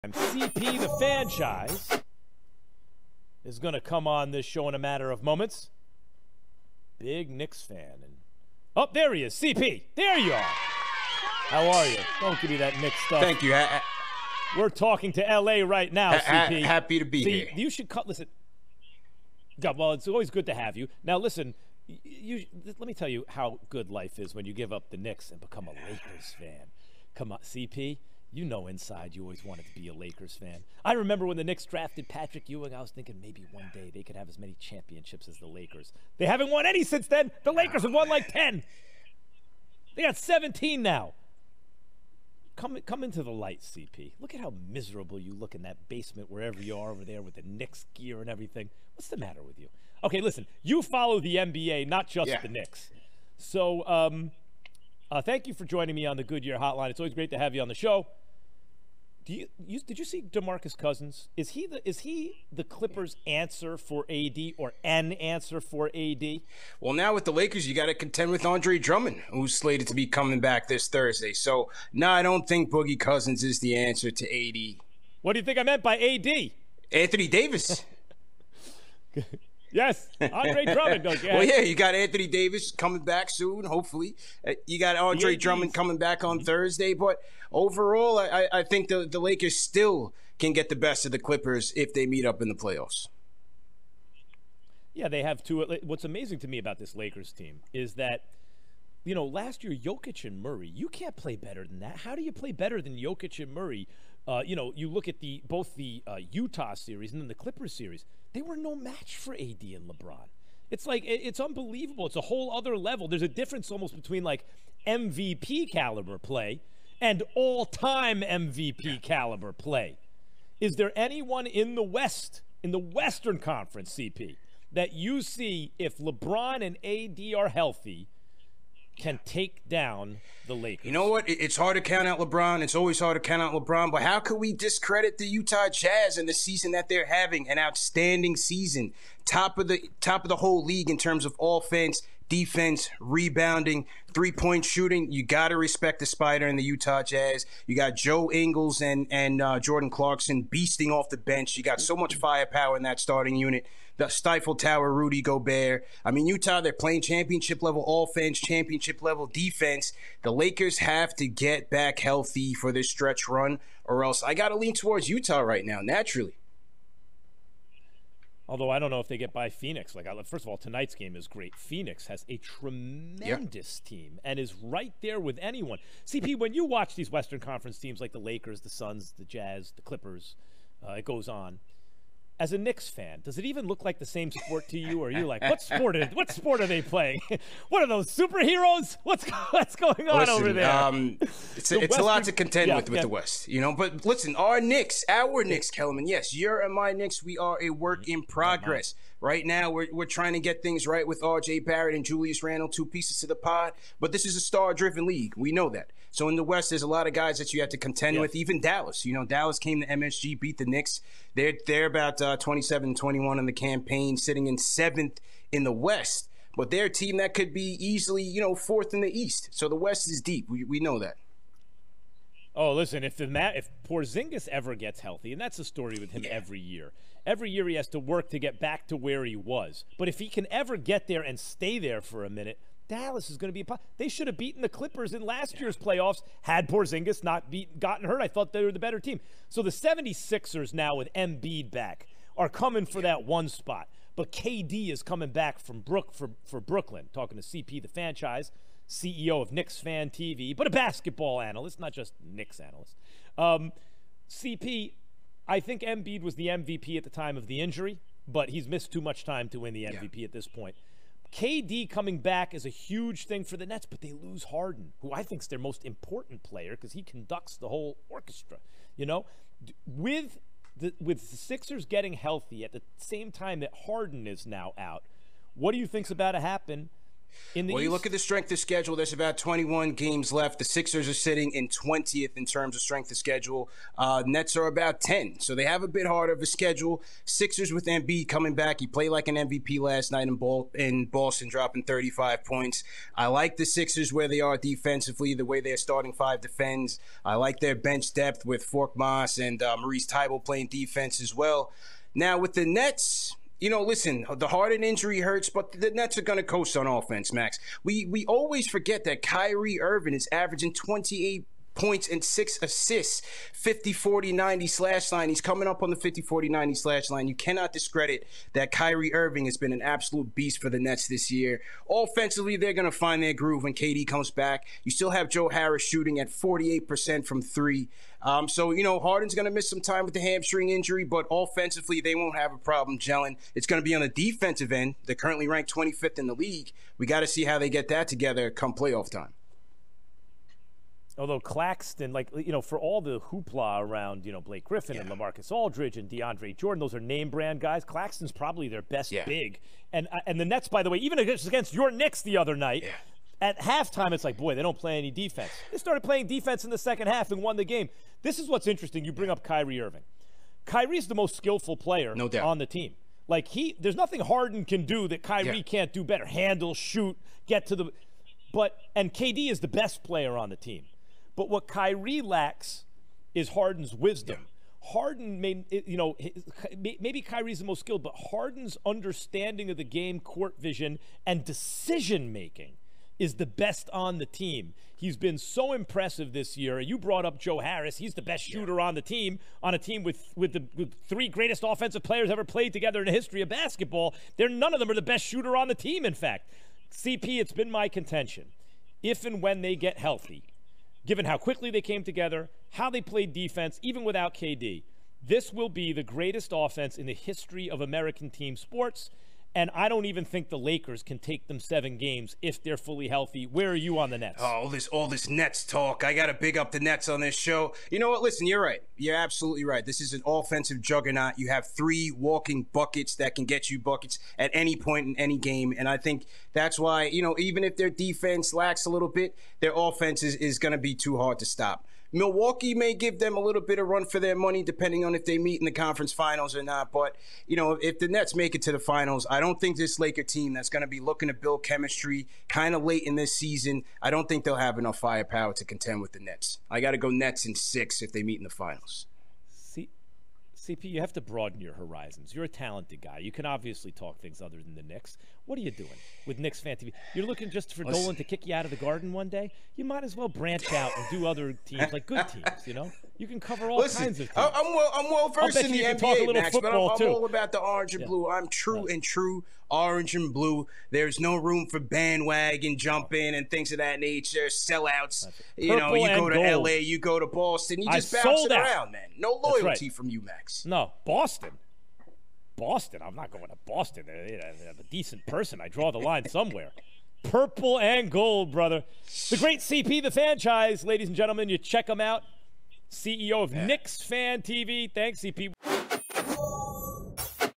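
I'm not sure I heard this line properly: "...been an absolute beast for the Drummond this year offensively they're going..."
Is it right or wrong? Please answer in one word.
wrong.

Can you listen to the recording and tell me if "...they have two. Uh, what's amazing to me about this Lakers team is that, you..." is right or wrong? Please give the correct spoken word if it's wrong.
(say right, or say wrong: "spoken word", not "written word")
right.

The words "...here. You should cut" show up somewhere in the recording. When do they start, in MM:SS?
00:17.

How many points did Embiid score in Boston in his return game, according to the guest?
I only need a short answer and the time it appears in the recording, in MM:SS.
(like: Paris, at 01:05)
35, at 04:51.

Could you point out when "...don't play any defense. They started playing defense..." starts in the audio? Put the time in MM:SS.
05:54.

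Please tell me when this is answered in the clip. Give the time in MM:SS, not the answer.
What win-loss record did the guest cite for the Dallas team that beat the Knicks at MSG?
03:32.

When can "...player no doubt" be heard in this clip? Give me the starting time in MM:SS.
06:01.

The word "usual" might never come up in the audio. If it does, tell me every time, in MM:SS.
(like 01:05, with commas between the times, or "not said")
not said.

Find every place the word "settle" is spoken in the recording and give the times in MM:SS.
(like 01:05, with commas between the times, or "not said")
not said.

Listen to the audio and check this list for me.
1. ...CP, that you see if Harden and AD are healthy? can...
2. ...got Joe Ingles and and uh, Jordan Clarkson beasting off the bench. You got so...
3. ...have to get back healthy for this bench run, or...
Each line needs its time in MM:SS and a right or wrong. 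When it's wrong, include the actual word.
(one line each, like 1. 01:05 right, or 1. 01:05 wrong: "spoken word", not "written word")
1. 02:03 wrong: "LeBron", not "Harden"
2. 02:27 right
3. 02:40 wrong: "stretch", not "bench".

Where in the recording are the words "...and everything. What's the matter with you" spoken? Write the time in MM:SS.
00:48.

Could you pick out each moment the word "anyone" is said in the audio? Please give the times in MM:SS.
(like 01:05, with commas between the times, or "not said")
02:00, 02:55.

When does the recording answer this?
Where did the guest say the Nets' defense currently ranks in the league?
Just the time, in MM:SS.
05:35.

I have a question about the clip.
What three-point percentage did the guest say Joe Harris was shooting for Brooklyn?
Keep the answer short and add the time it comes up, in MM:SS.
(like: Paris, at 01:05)
48%, at 05:26.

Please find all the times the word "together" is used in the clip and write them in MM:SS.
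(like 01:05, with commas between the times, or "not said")
05:38, 06:32, 06:42.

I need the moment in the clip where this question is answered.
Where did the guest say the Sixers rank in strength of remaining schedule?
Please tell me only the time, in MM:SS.
04:41.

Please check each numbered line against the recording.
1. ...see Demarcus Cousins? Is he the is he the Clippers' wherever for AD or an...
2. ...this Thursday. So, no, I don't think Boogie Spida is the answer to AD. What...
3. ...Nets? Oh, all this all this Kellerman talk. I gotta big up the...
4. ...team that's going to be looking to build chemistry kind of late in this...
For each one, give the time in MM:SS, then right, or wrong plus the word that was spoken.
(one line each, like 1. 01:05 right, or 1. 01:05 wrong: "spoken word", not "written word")
1. 01:00 wrong: "answer", not "wherever"
2. 01:10 wrong: "Cousins", not "Spida"
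3. 06:54 wrong: "Nets", not "Kellerman"
4. 07:20 right.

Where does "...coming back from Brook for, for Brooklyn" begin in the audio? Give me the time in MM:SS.
04:05.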